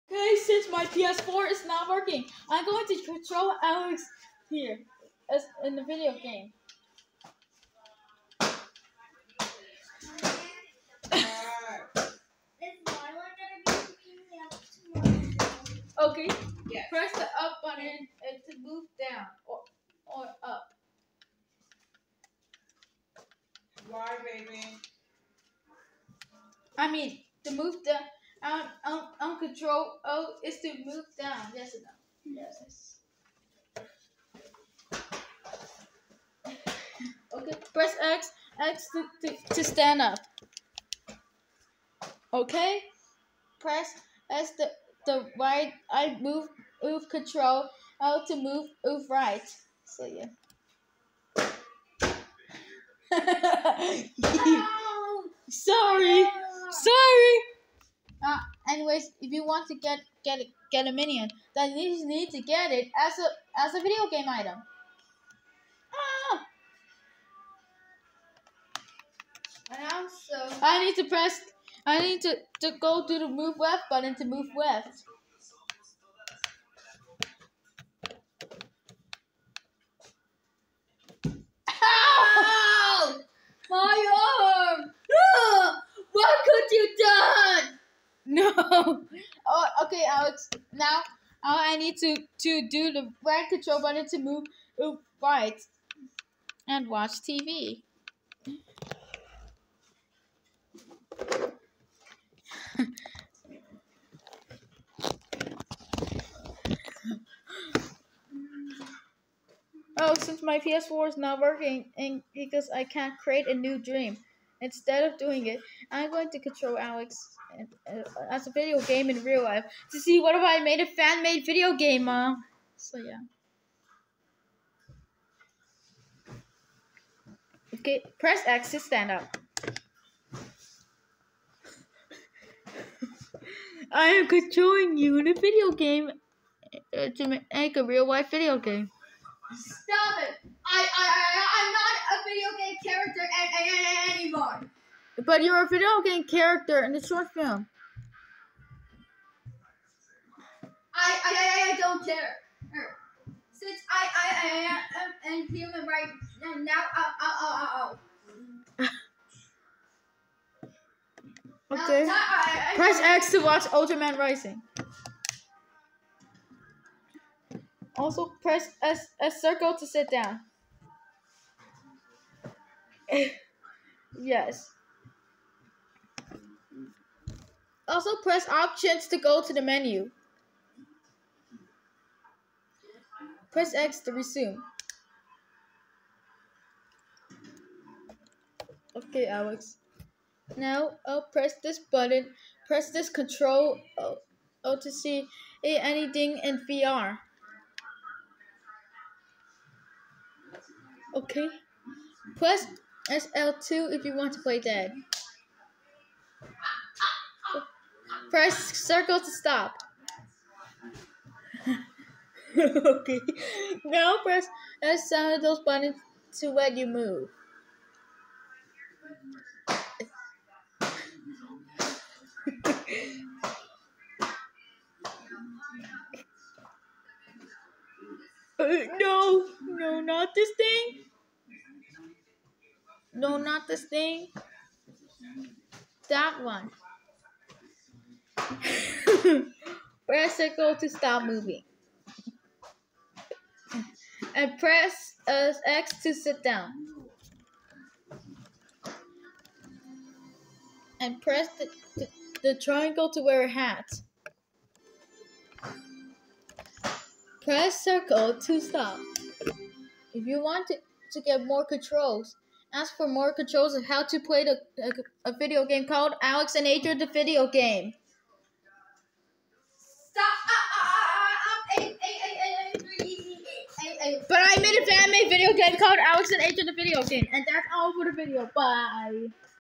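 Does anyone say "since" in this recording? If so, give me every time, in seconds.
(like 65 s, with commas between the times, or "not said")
110 s, 153 s.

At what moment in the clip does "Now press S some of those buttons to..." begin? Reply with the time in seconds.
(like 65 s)
213 s.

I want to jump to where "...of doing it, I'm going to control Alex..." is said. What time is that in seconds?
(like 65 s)
115 s.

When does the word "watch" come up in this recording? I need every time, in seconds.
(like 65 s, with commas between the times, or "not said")
96 s, 163 s.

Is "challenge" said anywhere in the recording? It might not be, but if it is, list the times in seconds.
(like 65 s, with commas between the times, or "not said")
not said.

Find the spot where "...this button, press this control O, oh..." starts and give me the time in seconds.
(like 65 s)
191 s.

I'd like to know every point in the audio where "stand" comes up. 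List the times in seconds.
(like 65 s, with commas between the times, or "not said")
39 s, 128 s.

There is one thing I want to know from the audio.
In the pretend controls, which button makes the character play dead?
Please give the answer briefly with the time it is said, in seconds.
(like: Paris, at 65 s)
SL2, at 203 s.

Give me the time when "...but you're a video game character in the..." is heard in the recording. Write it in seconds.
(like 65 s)
145 s.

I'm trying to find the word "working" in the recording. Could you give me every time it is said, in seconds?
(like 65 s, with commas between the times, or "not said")
1 s, 111 s.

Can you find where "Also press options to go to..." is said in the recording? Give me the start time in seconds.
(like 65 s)
177 s.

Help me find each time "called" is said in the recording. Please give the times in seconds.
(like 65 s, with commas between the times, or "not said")
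265 s, 275 s.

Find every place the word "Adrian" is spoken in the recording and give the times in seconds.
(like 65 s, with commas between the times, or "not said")
266 s, 276 s.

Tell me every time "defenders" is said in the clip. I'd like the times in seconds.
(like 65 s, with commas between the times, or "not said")
not said.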